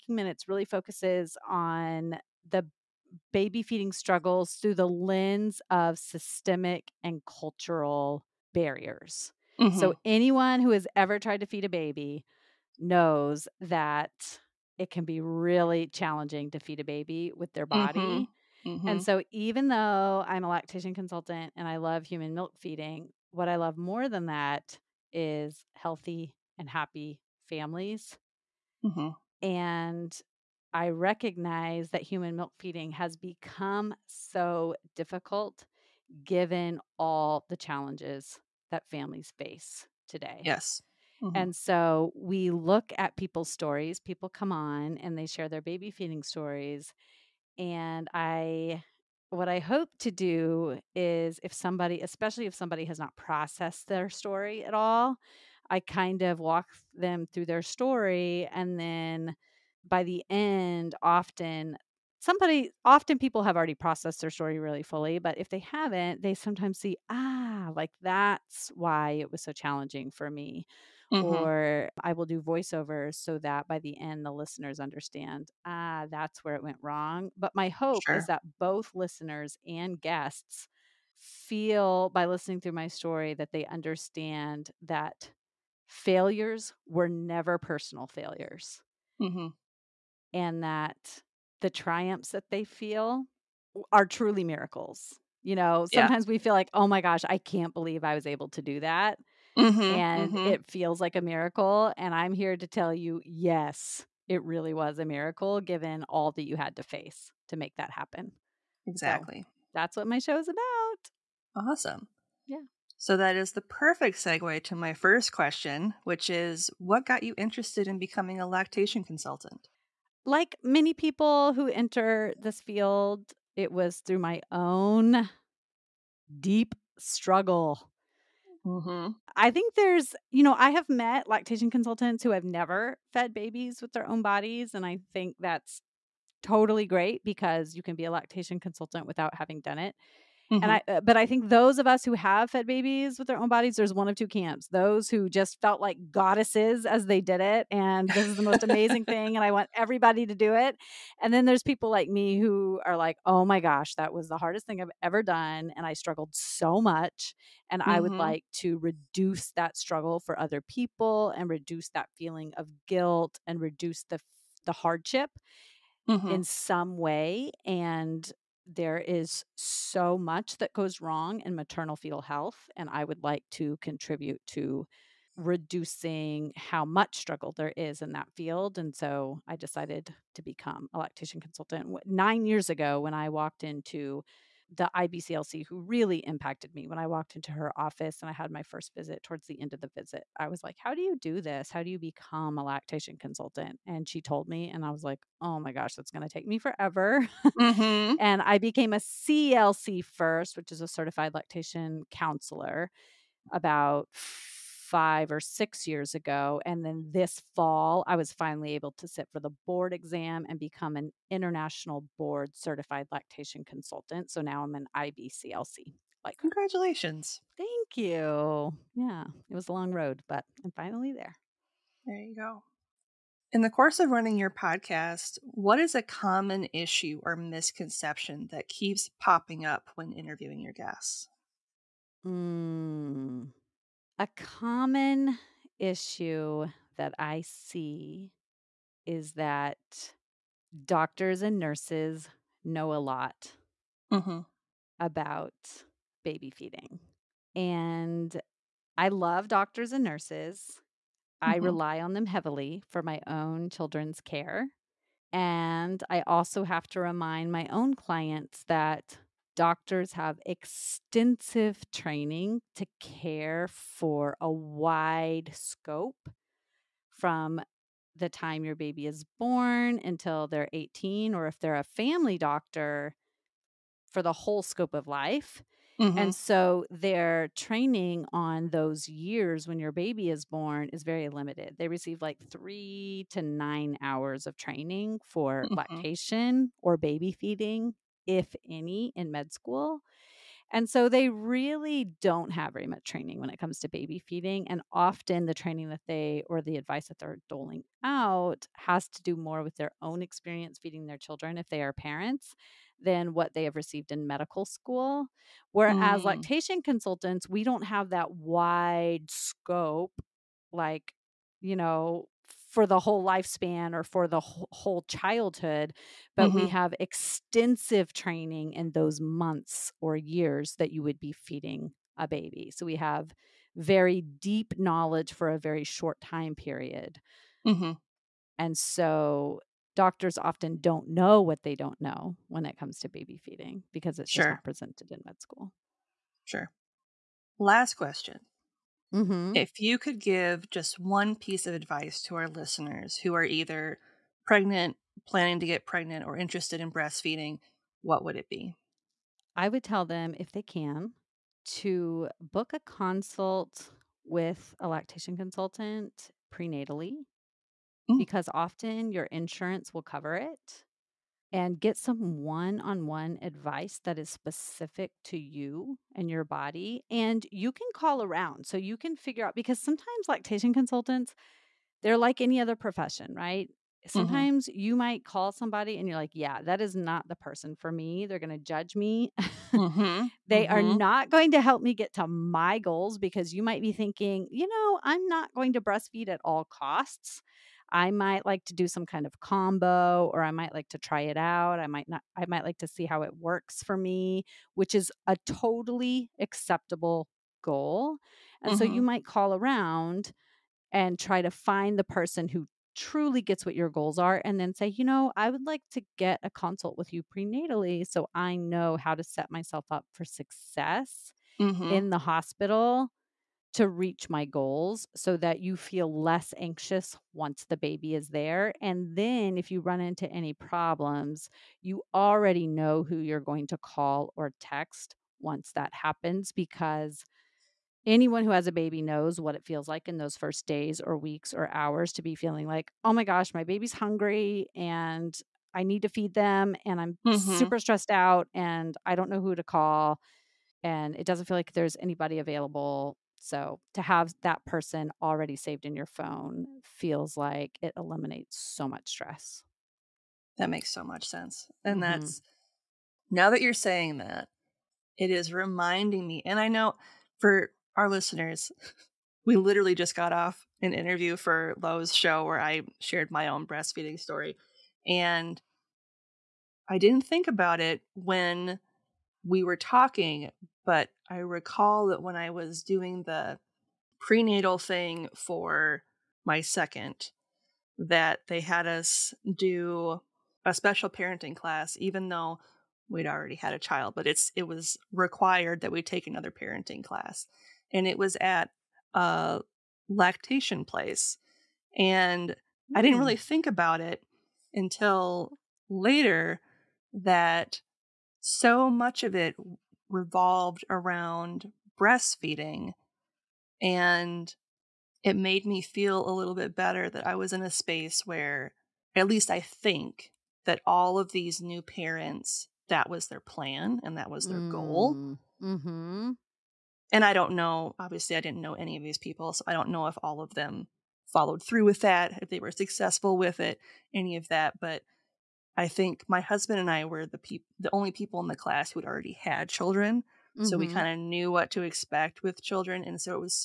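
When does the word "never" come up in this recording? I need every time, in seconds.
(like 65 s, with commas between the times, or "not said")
87 s, 132 s.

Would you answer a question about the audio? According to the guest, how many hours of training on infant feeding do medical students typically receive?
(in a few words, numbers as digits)
3 to 9 hours.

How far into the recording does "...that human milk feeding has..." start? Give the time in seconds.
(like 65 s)
31 s.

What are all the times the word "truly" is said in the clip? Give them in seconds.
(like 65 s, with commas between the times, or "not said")
94 s, 402 s.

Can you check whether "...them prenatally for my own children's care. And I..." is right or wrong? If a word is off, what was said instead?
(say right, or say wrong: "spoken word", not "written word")
wrong: "heavily", not "prenatally".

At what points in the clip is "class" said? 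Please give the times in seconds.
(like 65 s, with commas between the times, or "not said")
481 s, 487 s, 528 s.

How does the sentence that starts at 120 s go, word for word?
Like many people who enter this field, it was through my own deep struggle Mm-hmm.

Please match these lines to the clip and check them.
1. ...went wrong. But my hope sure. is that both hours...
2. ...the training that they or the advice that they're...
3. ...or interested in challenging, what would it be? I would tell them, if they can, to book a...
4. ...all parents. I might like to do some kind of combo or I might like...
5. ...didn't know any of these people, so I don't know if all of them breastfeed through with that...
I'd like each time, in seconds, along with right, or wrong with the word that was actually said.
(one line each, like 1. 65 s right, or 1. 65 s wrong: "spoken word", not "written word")
1. 76 s wrong: "listeners", not "hours"
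2. 295 s right
3. 346 s wrong: "breastfeeding", not "challenging"
4. 386 s wrong: "costs", not "parents"
5. 518 s wrong: "followed", not "breastfeed".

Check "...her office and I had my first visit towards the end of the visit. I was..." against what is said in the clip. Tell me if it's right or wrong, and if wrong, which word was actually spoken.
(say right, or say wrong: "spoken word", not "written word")
right.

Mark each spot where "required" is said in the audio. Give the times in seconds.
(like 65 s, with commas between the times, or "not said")
485 s.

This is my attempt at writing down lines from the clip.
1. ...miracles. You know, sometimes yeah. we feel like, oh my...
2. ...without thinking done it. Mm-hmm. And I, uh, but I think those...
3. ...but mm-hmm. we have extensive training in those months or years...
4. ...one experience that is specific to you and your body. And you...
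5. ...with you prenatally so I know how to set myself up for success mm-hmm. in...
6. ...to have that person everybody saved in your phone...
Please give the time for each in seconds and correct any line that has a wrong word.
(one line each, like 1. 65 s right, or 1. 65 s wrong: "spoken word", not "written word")
1. 94 s right
2. 139 s wrong: "having", not "thinking"
3. 316 s right
4. 363 s wrong: "advice", not "experience"
5. 406 s right
6. 443 s wrong: "already", not "everybody".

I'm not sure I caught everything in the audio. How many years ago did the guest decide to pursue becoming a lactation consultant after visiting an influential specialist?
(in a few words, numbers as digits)
9 years.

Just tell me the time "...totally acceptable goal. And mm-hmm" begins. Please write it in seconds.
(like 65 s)
395 s.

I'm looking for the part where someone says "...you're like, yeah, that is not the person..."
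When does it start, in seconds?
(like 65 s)
376 s.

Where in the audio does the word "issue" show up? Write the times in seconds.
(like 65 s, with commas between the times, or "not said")
226 s, 235 s.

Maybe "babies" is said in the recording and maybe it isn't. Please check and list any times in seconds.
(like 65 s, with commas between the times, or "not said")
133 s, 142 s.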